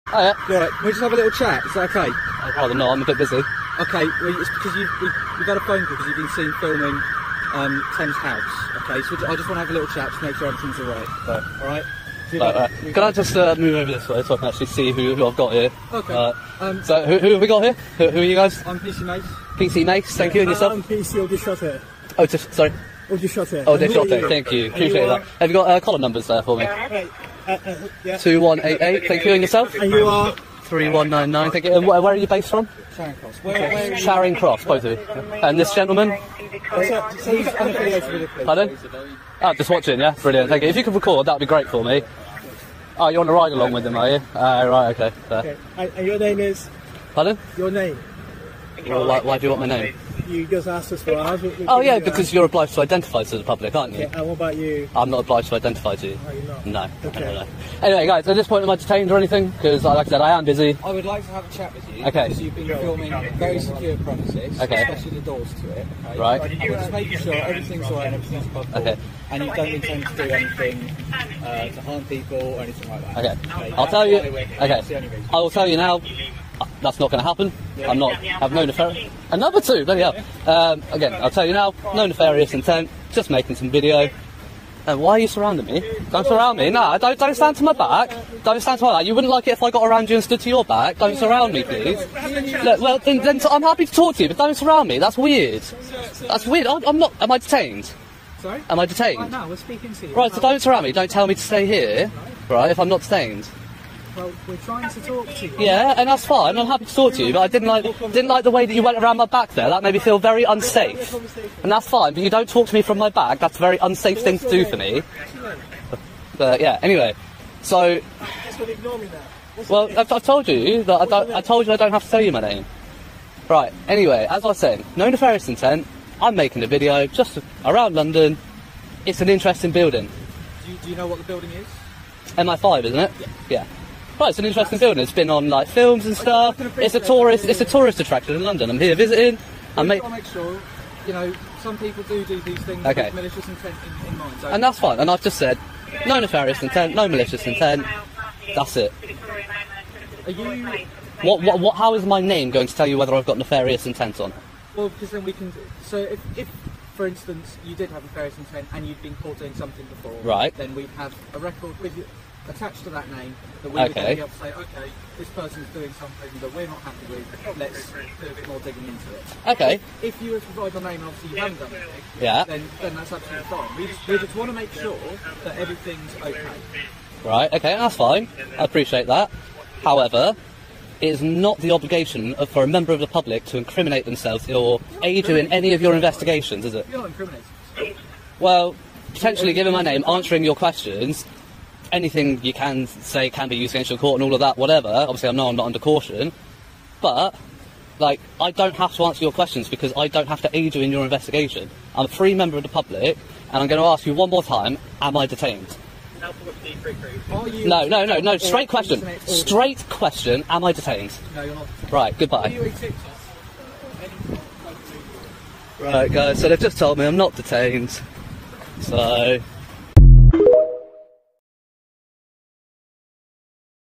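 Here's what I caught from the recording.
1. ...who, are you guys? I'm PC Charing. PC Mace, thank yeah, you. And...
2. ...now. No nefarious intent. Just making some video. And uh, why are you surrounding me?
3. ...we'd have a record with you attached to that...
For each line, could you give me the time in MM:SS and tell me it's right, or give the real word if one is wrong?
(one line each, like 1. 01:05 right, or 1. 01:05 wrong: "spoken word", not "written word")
1. 00:18 wrong: "Mace", not "Charing"
2. 01:21 right
3. 02:40 right.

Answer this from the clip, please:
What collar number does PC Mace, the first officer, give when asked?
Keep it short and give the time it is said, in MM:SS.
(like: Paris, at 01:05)
2188, at 00:27.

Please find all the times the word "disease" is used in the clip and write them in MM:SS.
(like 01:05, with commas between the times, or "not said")
not said.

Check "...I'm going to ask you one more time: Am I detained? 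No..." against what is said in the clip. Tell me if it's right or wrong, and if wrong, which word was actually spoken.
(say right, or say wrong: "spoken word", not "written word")
right.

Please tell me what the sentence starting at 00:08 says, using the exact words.
Okay, so I just want to have a little chat to make sure everything's alright.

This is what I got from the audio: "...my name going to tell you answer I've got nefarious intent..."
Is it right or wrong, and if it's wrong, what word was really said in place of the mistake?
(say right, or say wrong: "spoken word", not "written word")
wrong: "whether", not "answer".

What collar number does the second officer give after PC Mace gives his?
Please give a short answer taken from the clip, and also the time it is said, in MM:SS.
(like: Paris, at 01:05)
3199, at 00:30.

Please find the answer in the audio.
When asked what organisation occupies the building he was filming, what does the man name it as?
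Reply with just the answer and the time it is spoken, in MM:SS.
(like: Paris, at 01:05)
MI5, at 02:12.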